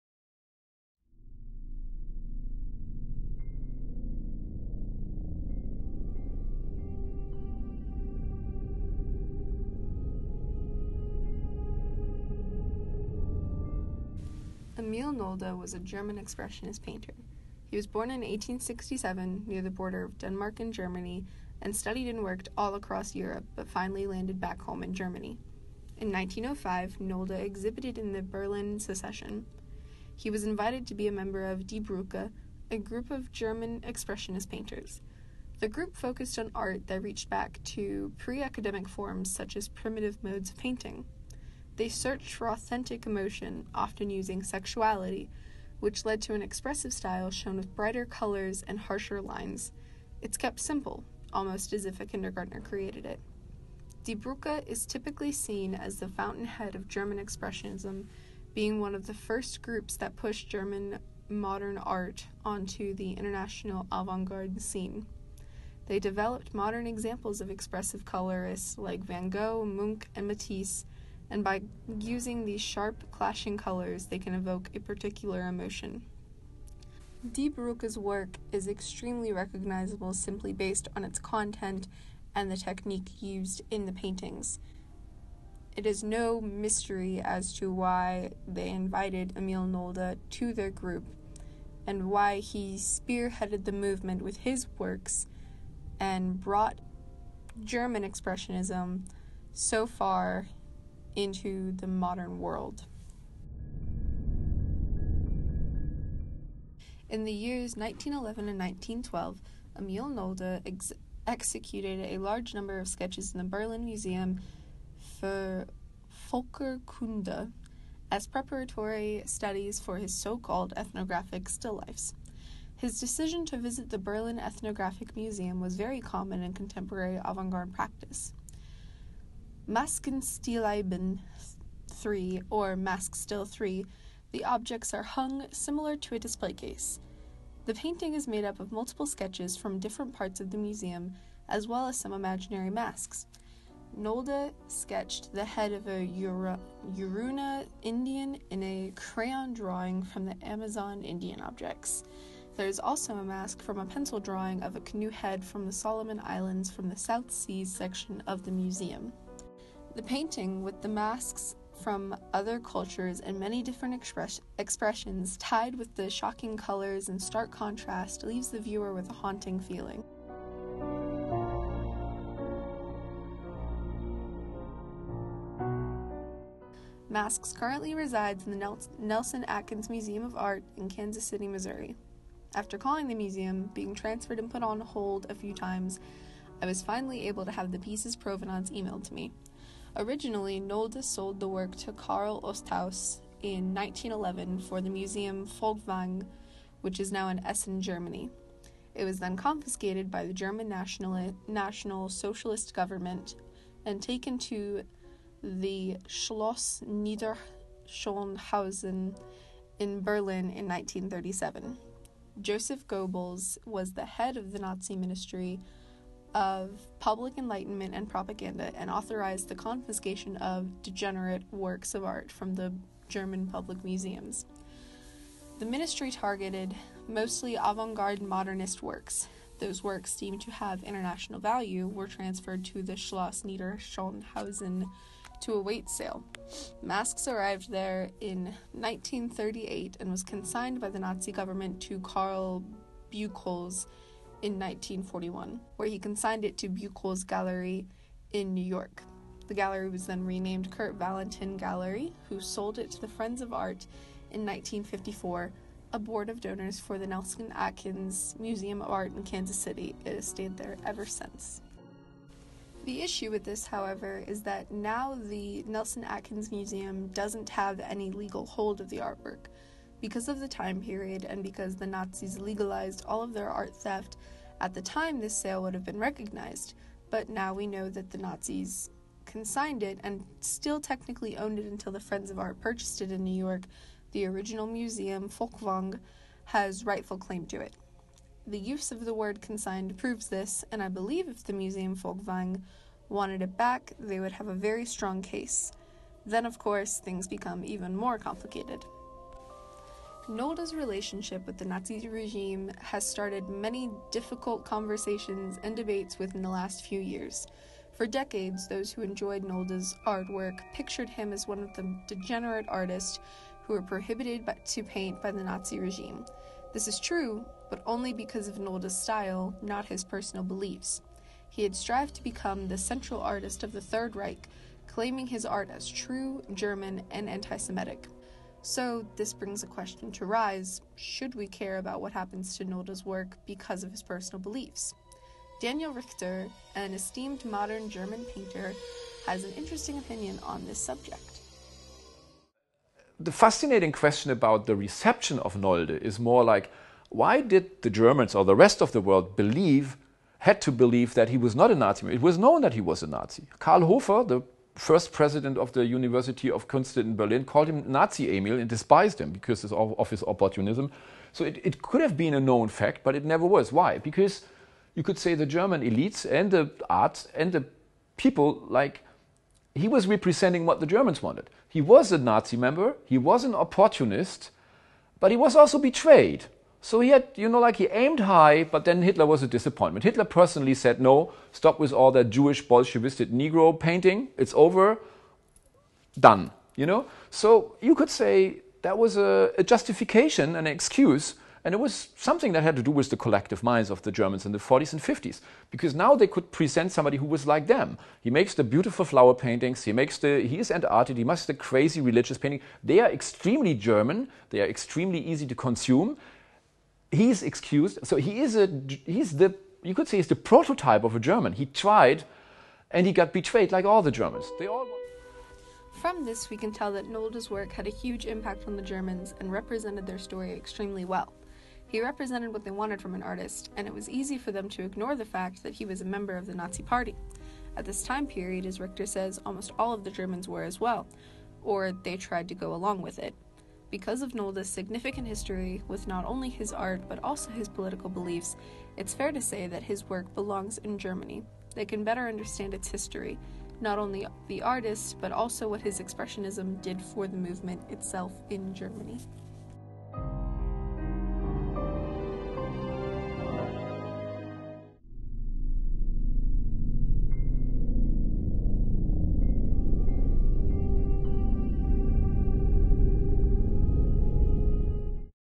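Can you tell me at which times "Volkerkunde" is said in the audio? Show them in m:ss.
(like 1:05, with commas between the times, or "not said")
1:56.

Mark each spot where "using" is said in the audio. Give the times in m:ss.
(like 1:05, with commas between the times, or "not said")
0:44, 1:11.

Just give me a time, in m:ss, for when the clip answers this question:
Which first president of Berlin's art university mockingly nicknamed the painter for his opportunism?
5:53.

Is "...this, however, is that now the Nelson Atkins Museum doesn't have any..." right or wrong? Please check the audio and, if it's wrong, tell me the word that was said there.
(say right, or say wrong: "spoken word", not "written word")
right.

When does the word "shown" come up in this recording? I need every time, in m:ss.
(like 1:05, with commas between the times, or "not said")
0:47.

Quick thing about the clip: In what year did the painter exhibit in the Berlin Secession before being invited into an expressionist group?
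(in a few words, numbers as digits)
1905.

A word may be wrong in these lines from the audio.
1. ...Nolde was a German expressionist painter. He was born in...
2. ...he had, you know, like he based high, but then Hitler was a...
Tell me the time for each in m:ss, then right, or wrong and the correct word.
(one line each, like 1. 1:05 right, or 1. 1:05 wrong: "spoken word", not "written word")
1. 0:15 right
2. 6:16 wrong: "aimed", not "based".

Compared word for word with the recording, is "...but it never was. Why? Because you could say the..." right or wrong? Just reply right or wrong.
right.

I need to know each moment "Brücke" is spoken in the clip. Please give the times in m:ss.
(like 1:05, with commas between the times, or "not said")
0:31, 0:54, 1:17.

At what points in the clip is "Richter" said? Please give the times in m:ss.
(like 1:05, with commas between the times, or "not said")
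5:35, 7:08.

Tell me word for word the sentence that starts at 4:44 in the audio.
The original museum, Folkwang, has rightful claim to it.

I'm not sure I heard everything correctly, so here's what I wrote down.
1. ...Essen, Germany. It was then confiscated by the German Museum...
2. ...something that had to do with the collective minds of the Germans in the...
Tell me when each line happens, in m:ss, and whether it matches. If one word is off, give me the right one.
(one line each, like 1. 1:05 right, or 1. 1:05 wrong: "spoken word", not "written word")
1. 3:17 wrong: "National", not "Museum"
2. 6:32 right.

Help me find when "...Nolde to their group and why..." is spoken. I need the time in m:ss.
1:29.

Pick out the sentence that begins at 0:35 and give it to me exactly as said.
The group focused on art that reached back to pre academic forms such as primitive modes of painting.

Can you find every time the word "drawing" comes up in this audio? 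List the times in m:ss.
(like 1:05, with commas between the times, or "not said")
2:29, 2:34.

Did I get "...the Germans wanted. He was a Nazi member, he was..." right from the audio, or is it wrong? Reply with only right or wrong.
right.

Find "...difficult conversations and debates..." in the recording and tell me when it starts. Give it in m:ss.
5:04.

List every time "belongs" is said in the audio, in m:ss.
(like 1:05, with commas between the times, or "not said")
7:20.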